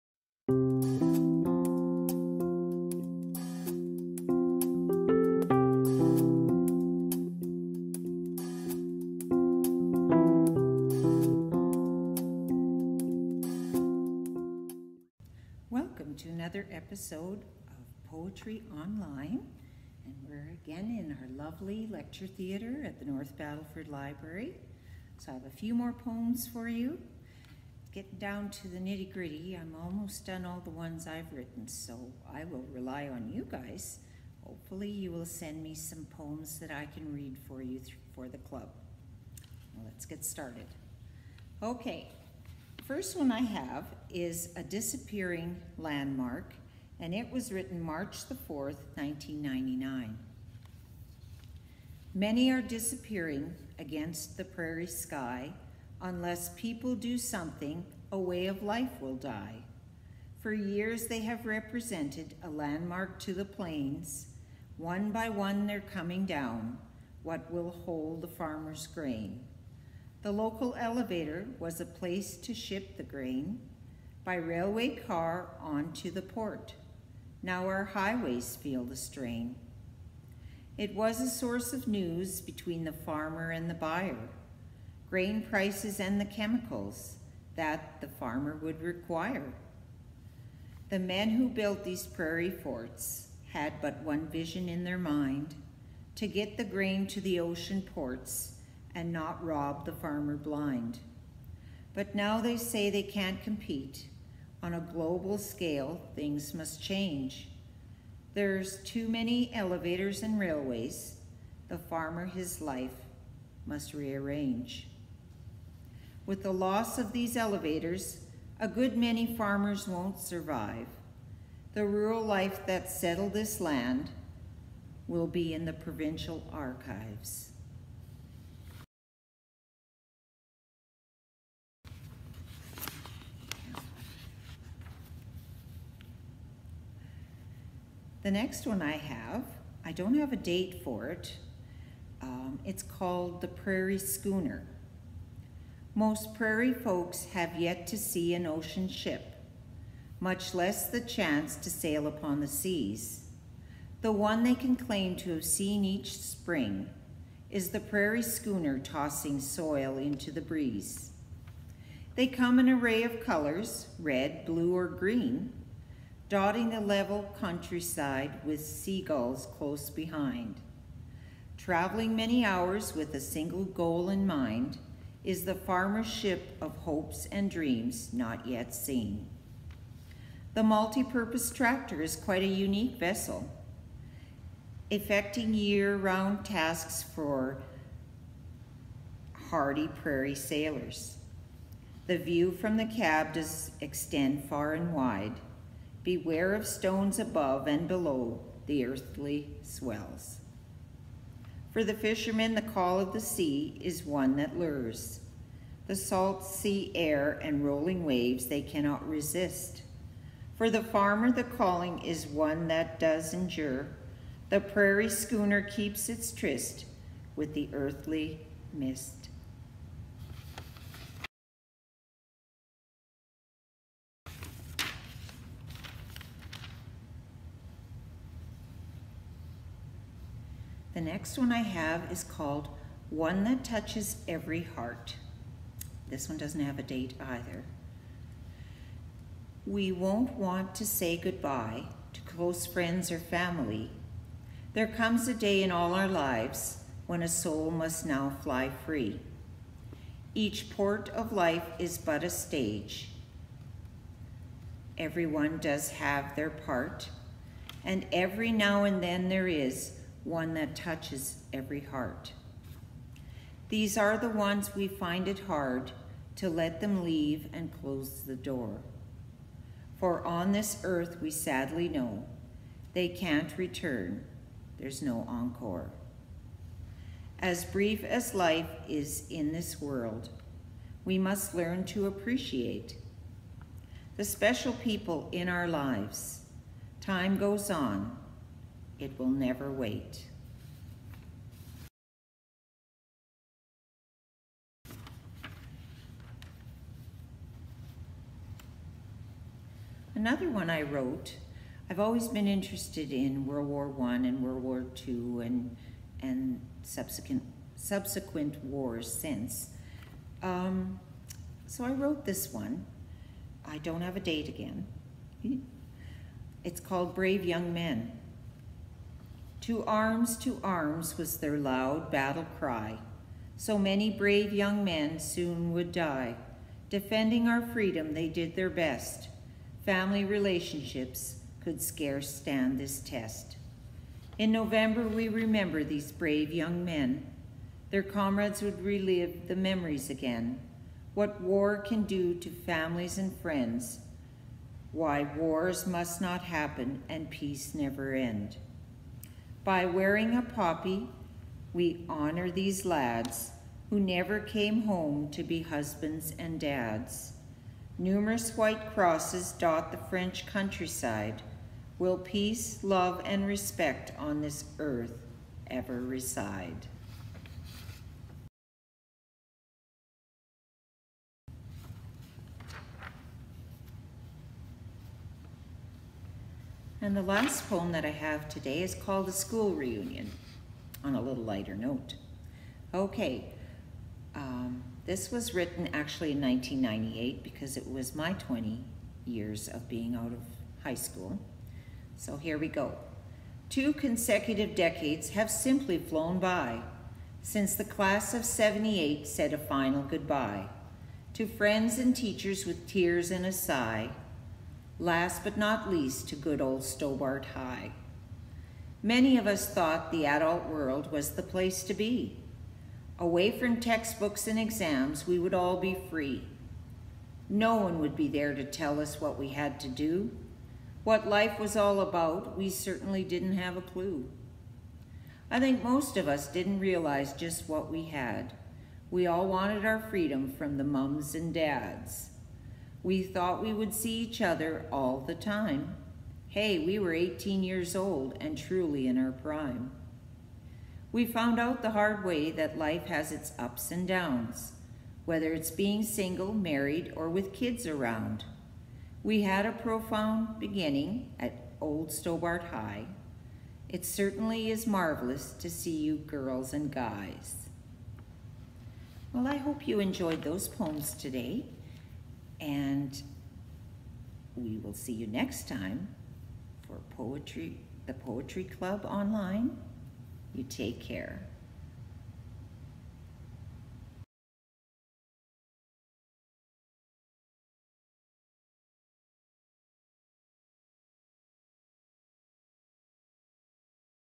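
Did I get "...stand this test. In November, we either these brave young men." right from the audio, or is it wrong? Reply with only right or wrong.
wrong.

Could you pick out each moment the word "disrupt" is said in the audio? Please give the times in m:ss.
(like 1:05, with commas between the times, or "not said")
not said.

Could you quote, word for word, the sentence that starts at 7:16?
Hey, we were 18 years old and truly in our prime.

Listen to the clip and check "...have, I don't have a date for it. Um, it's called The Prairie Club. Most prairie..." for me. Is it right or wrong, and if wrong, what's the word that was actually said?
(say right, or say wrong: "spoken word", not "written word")
wrong: "Schooner", not "Club".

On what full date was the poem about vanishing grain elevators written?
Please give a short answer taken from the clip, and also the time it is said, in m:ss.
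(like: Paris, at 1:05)
March 4, 1999, at 0:47.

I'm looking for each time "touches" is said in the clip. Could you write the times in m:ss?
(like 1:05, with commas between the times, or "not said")
3:53, 4:20.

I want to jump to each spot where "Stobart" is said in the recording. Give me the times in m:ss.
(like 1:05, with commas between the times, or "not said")
6:46, 7:32.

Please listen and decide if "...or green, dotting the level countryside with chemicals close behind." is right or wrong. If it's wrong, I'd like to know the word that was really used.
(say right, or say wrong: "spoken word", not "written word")
wrong: "seagulls", not "chemicals".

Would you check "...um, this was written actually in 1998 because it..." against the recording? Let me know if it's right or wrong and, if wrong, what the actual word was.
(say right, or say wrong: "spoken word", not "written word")
right.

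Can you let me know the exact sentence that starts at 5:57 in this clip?
Numerous white crosses dot the French countryside.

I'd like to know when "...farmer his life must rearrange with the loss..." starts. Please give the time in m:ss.
1:51.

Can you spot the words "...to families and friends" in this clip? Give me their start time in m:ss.
5:42.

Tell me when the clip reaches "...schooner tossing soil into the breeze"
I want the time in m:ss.
2:38.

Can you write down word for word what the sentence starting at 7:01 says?
What life was all about, we certainly didn't have a clue.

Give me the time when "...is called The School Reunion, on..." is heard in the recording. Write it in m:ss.
6:18.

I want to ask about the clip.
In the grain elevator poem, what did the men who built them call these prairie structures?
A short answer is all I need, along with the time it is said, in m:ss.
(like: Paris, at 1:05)
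Prairie forts, at 1:32.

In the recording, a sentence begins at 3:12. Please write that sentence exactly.
The view from the cab does extend far and wide.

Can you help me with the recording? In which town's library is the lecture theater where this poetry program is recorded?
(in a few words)
North Battleford.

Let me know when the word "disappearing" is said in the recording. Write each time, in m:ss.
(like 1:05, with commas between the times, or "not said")
0:44, 0:52.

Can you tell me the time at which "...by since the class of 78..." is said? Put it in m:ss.
6:36.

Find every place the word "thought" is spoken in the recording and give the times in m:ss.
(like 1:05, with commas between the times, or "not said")
6:49, 7:13.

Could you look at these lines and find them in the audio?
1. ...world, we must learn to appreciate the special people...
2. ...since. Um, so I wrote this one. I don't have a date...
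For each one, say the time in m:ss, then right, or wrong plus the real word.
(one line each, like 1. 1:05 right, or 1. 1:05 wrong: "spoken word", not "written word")
1. 4:39 right
2. 5:09 right.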